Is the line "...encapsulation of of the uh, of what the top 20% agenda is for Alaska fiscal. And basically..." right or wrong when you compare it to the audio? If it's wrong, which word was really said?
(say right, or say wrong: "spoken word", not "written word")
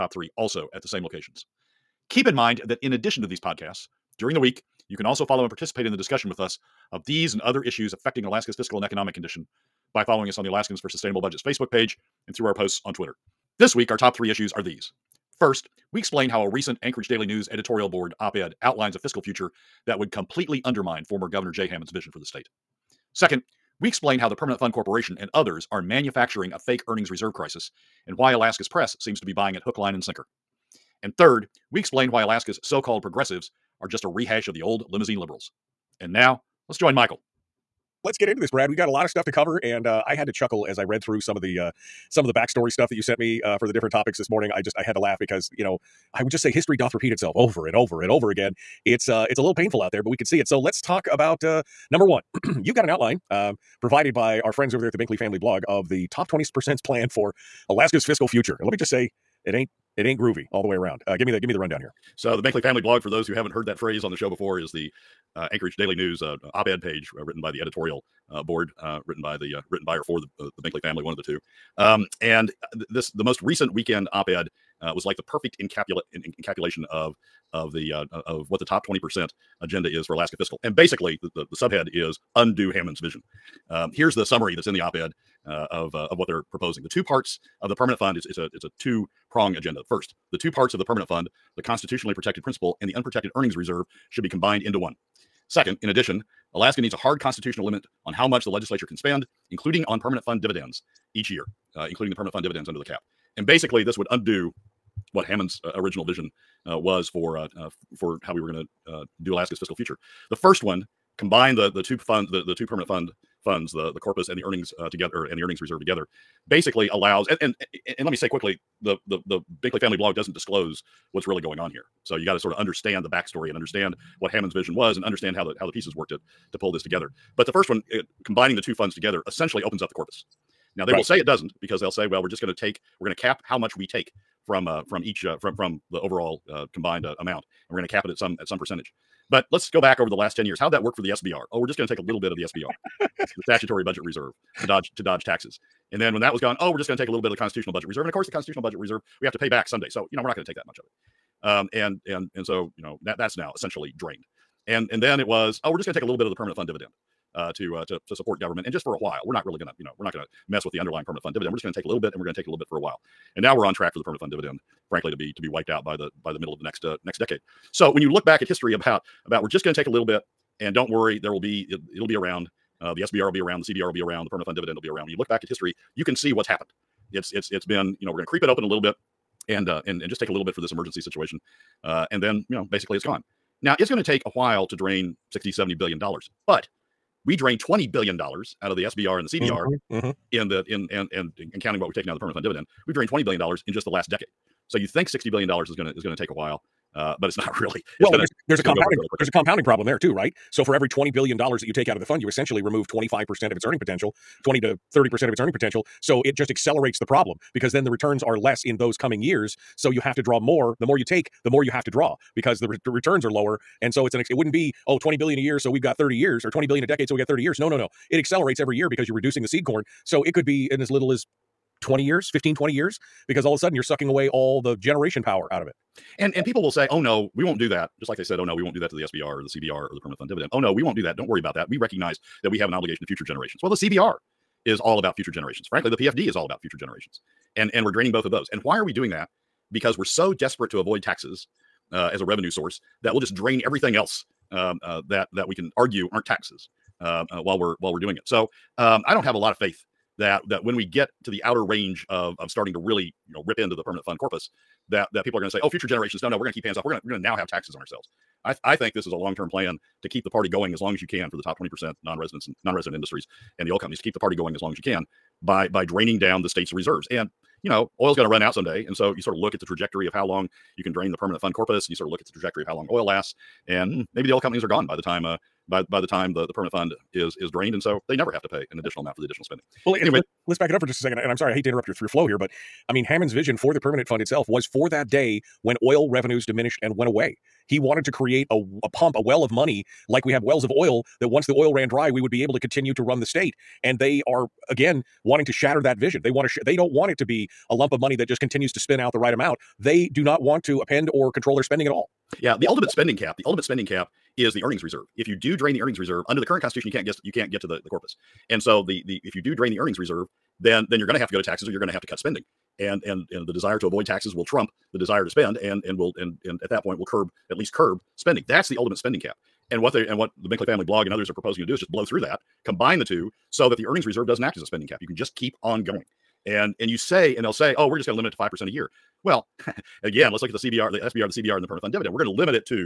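right.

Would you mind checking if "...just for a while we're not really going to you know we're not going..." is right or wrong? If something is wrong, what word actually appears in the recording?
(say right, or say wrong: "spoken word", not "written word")
right.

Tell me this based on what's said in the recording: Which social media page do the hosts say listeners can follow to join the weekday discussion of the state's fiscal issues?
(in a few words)
Alaskans for Sustainable Budgets.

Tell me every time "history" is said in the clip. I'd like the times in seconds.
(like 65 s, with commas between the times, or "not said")
46 s, 168 s, 175 s.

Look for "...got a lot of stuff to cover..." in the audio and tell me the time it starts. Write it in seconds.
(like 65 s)
38 s.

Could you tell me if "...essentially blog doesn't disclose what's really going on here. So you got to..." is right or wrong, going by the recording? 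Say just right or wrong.
wrong.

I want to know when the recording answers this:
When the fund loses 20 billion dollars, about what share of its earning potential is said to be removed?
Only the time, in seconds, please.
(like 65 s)
202 s.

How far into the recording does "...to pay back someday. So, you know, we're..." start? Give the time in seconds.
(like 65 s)
149 s.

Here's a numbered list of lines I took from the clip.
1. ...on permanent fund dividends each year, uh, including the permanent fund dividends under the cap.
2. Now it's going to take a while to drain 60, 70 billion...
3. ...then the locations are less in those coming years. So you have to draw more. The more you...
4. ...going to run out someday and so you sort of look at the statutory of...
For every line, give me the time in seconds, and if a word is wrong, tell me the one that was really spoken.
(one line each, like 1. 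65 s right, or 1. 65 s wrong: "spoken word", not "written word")
1. 99 s right
2. 183 s right
3. 207 s wrong: "returns", not "locations"
4. 268 s wrong: "trajectory", not "statutory".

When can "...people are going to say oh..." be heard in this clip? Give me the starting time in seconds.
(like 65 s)
255 s.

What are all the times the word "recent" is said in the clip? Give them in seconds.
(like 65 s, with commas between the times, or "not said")
16 s, 73 s.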